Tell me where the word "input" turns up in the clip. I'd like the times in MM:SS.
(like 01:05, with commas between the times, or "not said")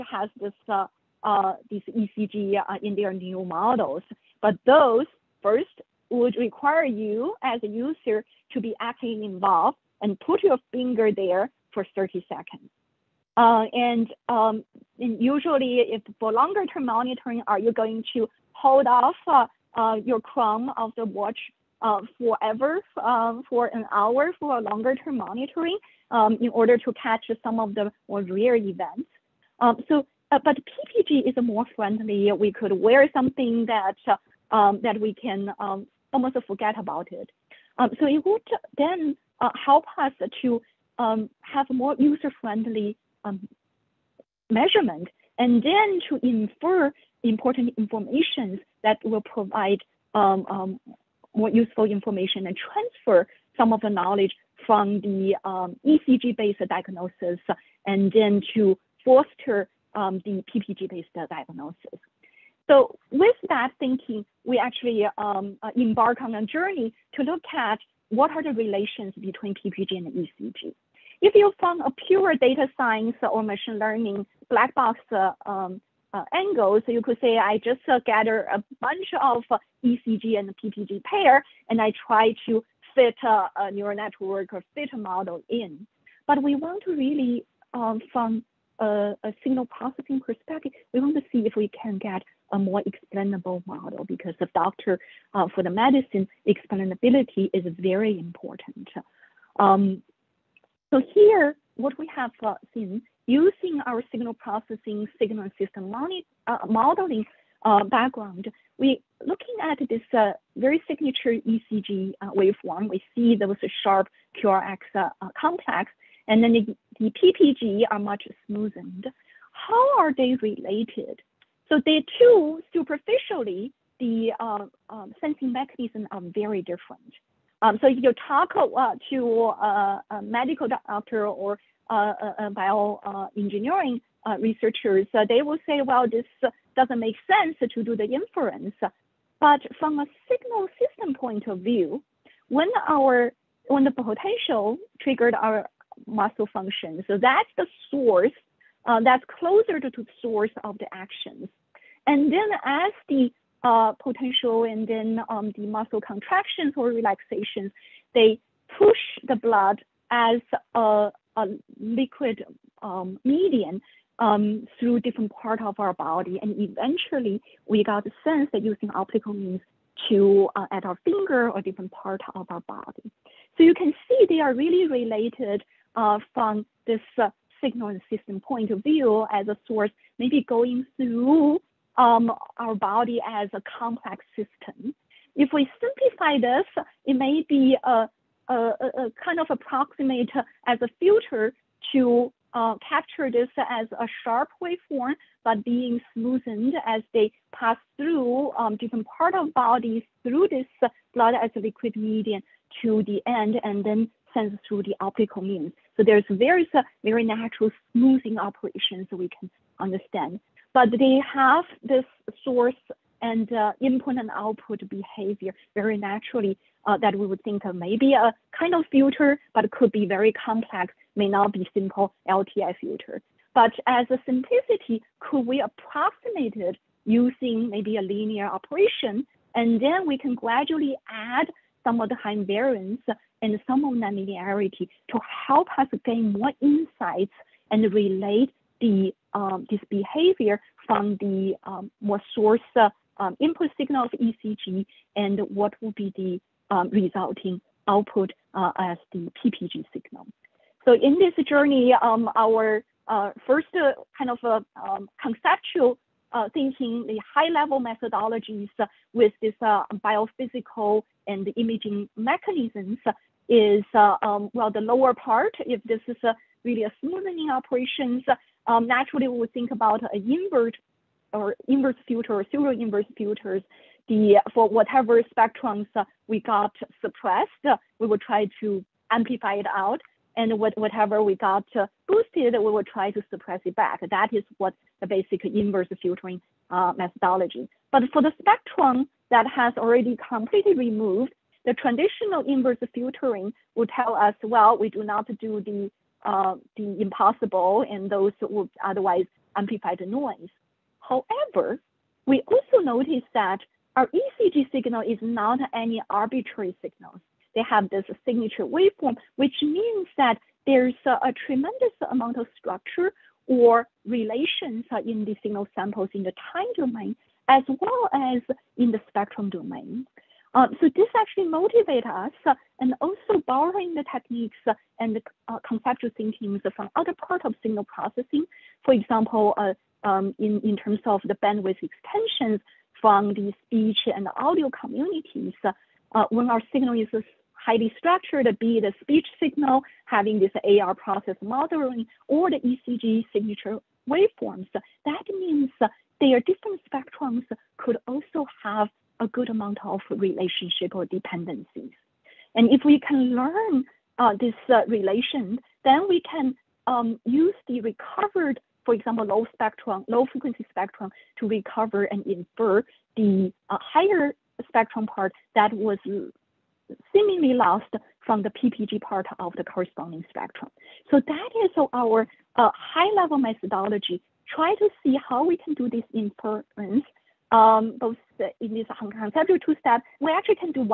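03:33, 04:03.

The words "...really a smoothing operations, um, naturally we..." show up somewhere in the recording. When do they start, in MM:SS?
04:26.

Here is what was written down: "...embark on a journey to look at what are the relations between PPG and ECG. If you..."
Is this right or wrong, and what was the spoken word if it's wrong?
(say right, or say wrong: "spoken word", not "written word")
right.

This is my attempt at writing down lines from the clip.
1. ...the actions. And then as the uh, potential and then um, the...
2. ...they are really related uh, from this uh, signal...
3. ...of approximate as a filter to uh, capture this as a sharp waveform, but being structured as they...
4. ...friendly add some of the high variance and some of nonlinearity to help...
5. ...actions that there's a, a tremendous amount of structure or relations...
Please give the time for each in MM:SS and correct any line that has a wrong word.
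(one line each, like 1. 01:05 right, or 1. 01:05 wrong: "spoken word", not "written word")
1. 02:30 right
2. 02:54 right
3. 03:09 wrong: "smoothed", not "structured"
4. 03:50 wrong: "gradually", not "friendly"
5. 05:09 wrong: "means", not "actions".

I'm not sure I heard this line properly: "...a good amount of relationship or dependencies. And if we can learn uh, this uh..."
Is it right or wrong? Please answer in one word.
right.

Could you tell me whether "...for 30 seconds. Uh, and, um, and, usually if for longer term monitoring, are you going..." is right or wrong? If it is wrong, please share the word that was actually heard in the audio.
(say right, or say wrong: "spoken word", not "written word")
right.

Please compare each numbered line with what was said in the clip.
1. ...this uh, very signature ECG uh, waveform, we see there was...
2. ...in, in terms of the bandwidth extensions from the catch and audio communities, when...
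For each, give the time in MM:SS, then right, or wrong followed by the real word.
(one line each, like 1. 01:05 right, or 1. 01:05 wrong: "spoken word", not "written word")
1. 01:49 right
2. 05:30 wrong: "speech", not "catch".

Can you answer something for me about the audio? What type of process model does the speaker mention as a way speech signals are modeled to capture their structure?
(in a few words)
AR process.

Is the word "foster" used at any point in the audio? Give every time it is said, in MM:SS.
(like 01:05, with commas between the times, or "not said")
00:59.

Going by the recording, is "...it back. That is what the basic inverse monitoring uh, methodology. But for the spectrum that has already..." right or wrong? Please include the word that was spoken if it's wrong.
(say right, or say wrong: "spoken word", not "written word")
wrong: "filtering", not "monitoring".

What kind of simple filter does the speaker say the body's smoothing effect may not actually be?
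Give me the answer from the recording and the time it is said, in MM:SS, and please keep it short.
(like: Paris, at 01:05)
LTI filter, at 03:42.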